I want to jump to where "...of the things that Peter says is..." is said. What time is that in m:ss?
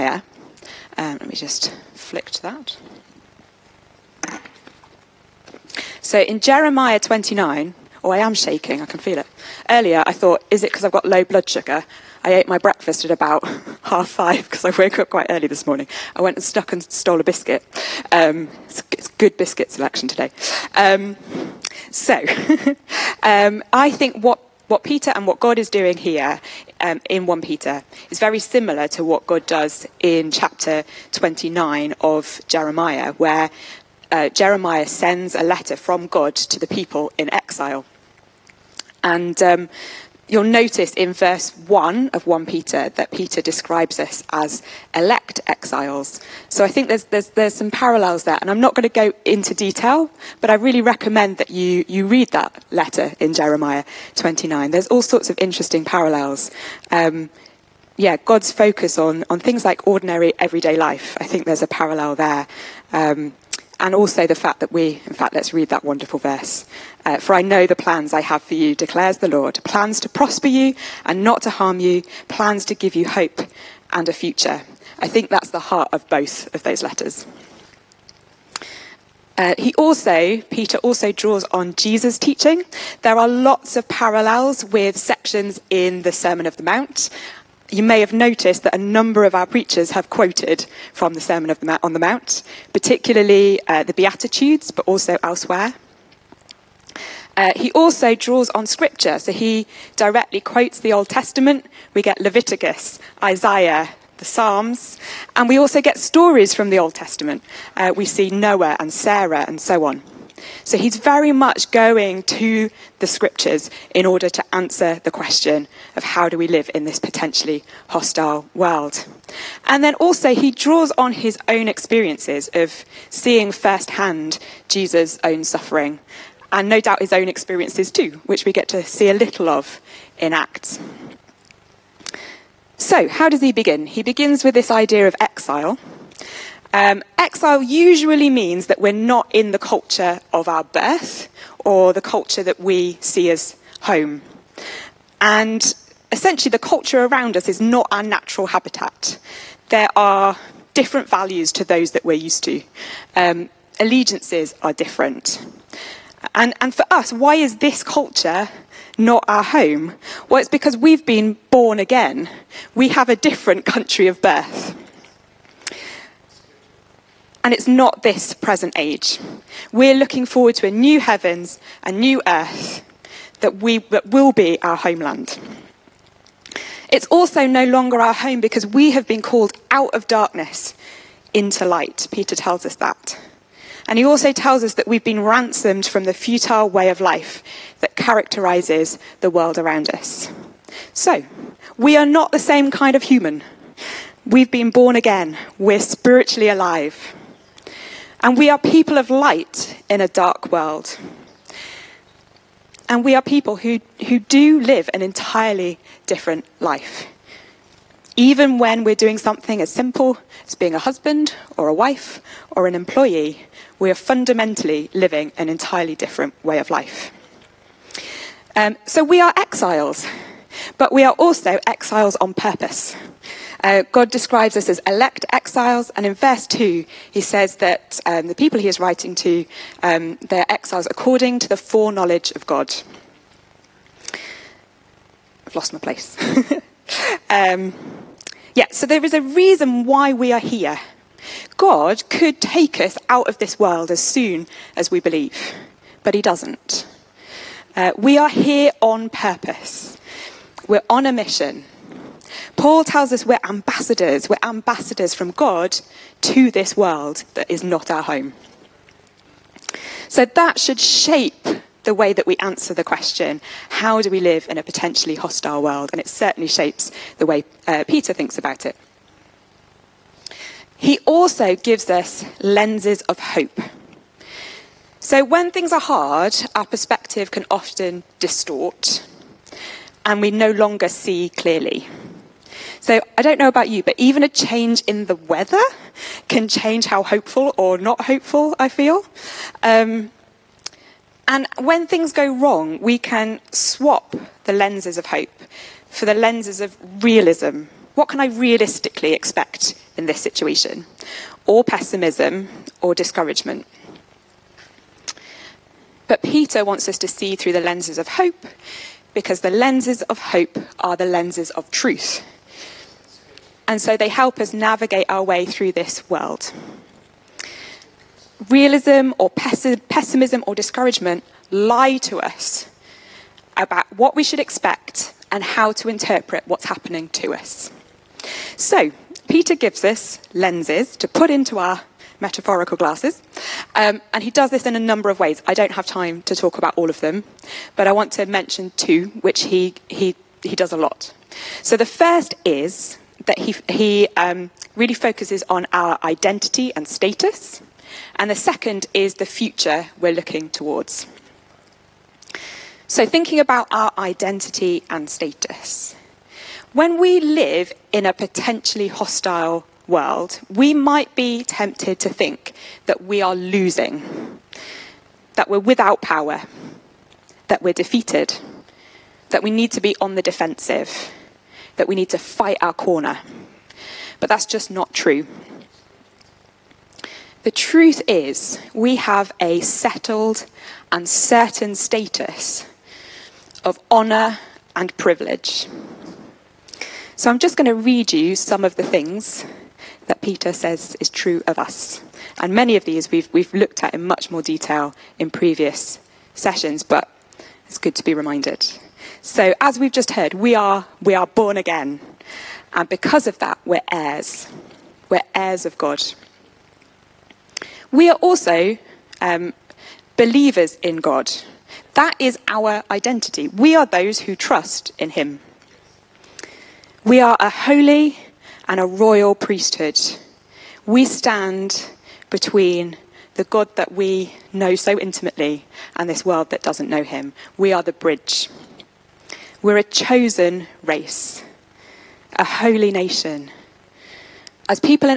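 6:28.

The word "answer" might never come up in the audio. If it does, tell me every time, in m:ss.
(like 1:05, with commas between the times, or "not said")
1:54, 4:22.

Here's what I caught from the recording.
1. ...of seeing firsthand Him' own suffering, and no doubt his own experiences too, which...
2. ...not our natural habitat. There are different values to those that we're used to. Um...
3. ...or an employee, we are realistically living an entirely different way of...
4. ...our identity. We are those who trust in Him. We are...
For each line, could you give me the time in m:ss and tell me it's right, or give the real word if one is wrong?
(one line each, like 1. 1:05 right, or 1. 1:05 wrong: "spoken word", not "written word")
1. 2:02 wrong: "Jesus", not "Him"
2. 2:27 right
3. 3:32 wrong: "fundamentally", not "realistically"
4. 6:52 right.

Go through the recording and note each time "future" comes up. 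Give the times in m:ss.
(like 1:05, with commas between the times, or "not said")
1:14, 5:49.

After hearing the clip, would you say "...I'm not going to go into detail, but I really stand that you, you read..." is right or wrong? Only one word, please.
wrong.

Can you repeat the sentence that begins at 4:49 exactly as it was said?
Um, and when things go wrong, we can swap the lenses of hope for the lenses of realism.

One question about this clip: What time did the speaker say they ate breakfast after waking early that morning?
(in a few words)
half five.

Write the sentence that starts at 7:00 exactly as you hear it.
We stand between the God that we know so intimately and this world that doesn't know Him.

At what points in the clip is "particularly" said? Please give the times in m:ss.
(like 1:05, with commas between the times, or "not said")
1:32.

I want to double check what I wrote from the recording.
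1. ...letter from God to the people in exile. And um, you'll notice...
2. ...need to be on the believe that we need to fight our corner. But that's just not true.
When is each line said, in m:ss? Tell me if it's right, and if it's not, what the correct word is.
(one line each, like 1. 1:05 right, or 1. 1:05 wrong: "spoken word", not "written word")
1. 0:35 right
2. 6:09 wrong: "defensive", not "believe".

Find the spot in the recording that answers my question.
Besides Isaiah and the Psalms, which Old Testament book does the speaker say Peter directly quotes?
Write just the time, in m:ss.
1:42.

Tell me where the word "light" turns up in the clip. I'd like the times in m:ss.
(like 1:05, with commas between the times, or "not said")
3:01, 3:19.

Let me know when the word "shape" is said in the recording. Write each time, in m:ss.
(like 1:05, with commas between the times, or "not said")
4:20, 4:26.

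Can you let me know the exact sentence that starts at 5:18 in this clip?
Realism or pessimism or discouragement lie to us about what we should expect and how to interpret what's happening to us.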